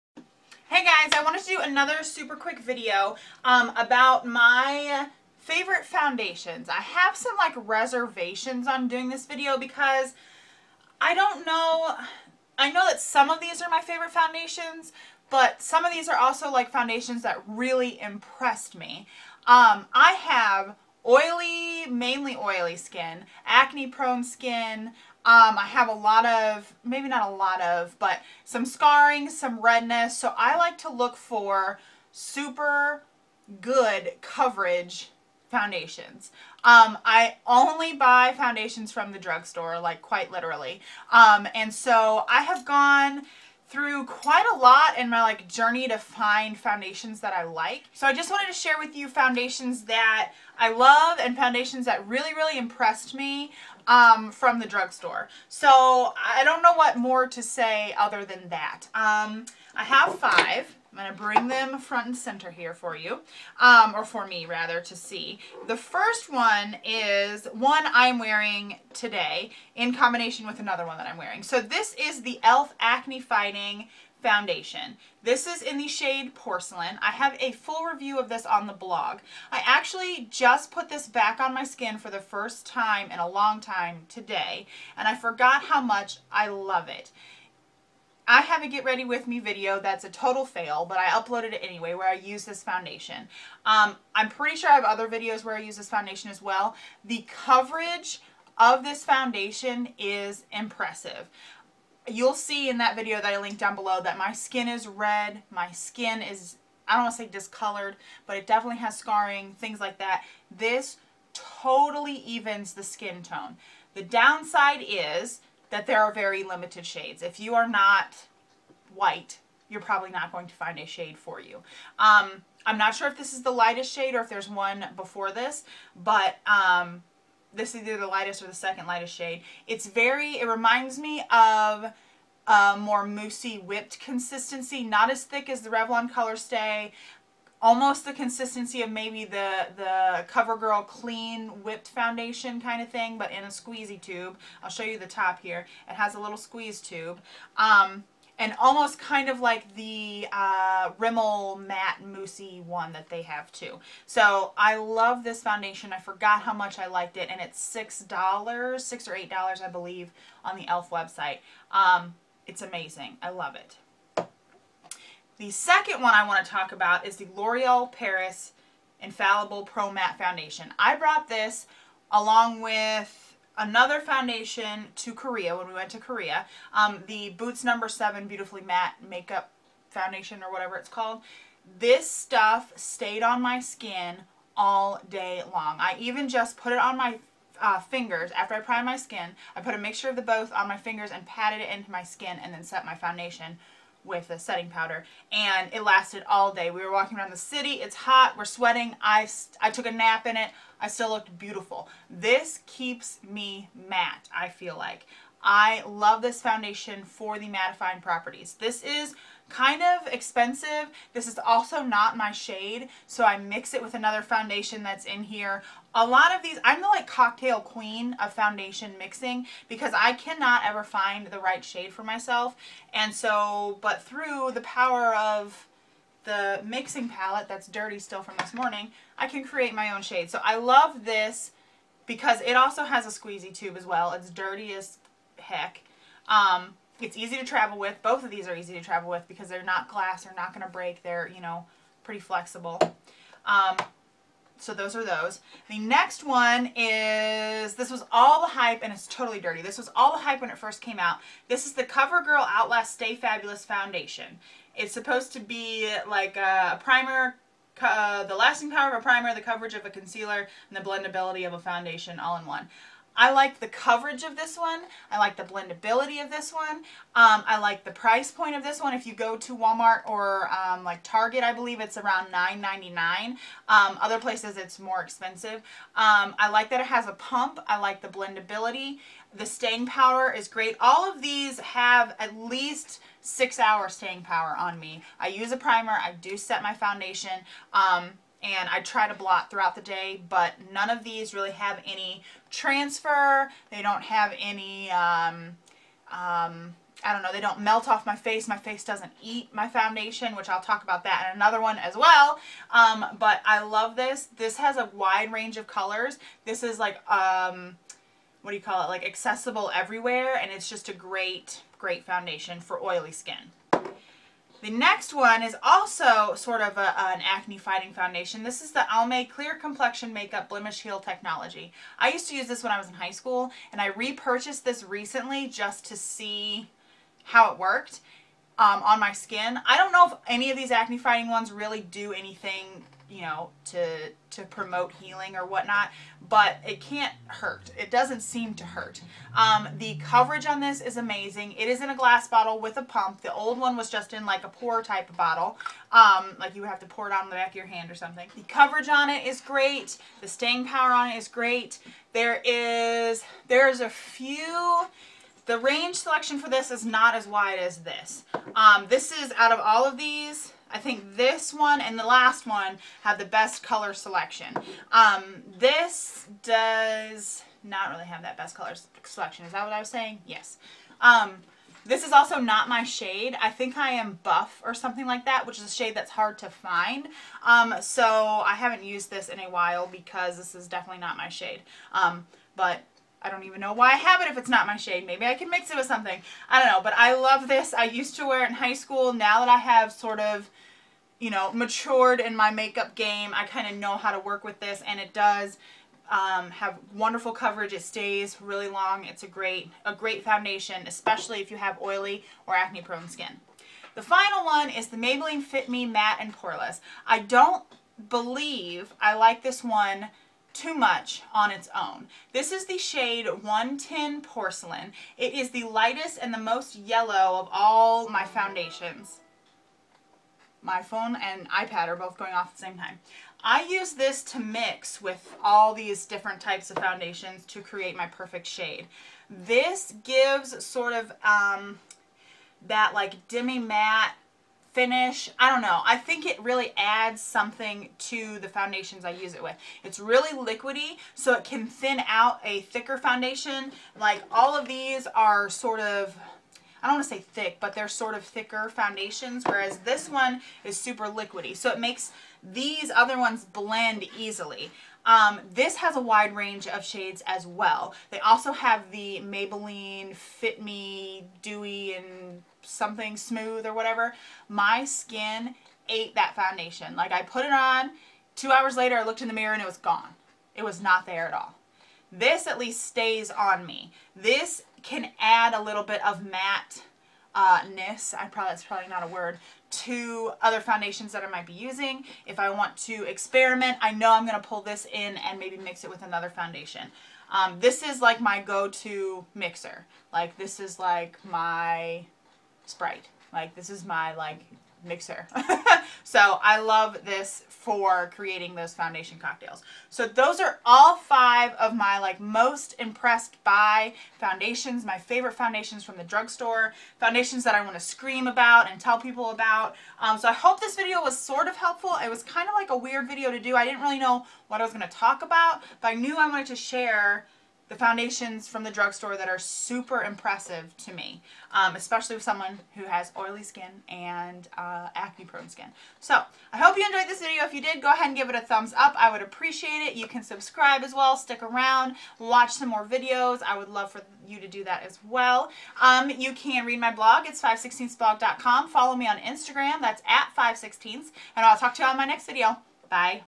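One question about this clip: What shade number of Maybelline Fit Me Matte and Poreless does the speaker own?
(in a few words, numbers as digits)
110.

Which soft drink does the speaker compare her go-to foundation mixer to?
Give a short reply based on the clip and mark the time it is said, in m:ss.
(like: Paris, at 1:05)
Sprite, at 8:12.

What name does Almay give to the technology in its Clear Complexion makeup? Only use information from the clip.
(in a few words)
Blemish Heal.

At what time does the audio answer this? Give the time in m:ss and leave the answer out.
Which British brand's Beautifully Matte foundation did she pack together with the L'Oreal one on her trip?
2:57.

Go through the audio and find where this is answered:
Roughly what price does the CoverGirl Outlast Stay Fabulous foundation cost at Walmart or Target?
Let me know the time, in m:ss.
4:32.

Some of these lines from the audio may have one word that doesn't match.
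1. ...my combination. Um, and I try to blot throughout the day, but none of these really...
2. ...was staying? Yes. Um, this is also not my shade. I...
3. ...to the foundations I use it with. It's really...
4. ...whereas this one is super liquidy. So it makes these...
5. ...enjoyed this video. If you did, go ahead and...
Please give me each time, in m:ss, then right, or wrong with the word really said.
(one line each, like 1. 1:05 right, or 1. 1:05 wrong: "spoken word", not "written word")
1. 4:46 wrong: "foundation", not "combination"
2. 6:09 wrong: "saying", not "staying"
3. 7:17 right
4. 7:29 right
5. 8:46 right.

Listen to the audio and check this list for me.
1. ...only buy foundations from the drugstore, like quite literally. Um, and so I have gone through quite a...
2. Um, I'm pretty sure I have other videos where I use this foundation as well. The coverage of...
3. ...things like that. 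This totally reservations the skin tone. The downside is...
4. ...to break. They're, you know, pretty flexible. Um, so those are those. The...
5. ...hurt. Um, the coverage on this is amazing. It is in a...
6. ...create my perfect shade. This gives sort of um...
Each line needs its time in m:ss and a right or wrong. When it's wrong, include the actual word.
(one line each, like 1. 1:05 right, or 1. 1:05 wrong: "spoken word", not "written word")
1. 0:37 right
2. 1:33 right
3. 1:49 wrong: "evens", not "reservations"
4. 4:00 right
5. 5:38 right
6. 7:07 right.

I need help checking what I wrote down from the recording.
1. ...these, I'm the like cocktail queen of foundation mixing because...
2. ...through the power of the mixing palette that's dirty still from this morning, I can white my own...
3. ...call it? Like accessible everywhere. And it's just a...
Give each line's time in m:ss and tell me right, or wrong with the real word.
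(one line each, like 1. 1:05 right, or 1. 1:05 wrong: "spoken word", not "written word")
1. 3:36 right
2. 3:44 wrong: "create", not "white"
3. 5:08 right.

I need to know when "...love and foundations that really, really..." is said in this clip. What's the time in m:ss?
0:50.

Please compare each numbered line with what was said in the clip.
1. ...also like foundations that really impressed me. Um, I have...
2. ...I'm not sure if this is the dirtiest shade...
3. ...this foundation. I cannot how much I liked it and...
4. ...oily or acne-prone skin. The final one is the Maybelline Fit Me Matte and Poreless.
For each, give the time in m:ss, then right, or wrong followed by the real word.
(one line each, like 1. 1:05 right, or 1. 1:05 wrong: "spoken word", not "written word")
1. 0:16 right
2. 2:02 wrong: "lightest", not "dirtiest"
3. 2:35 wrong: "forgot", not "cannot"
4. 6:41 right.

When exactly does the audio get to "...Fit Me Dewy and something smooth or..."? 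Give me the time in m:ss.
7:40.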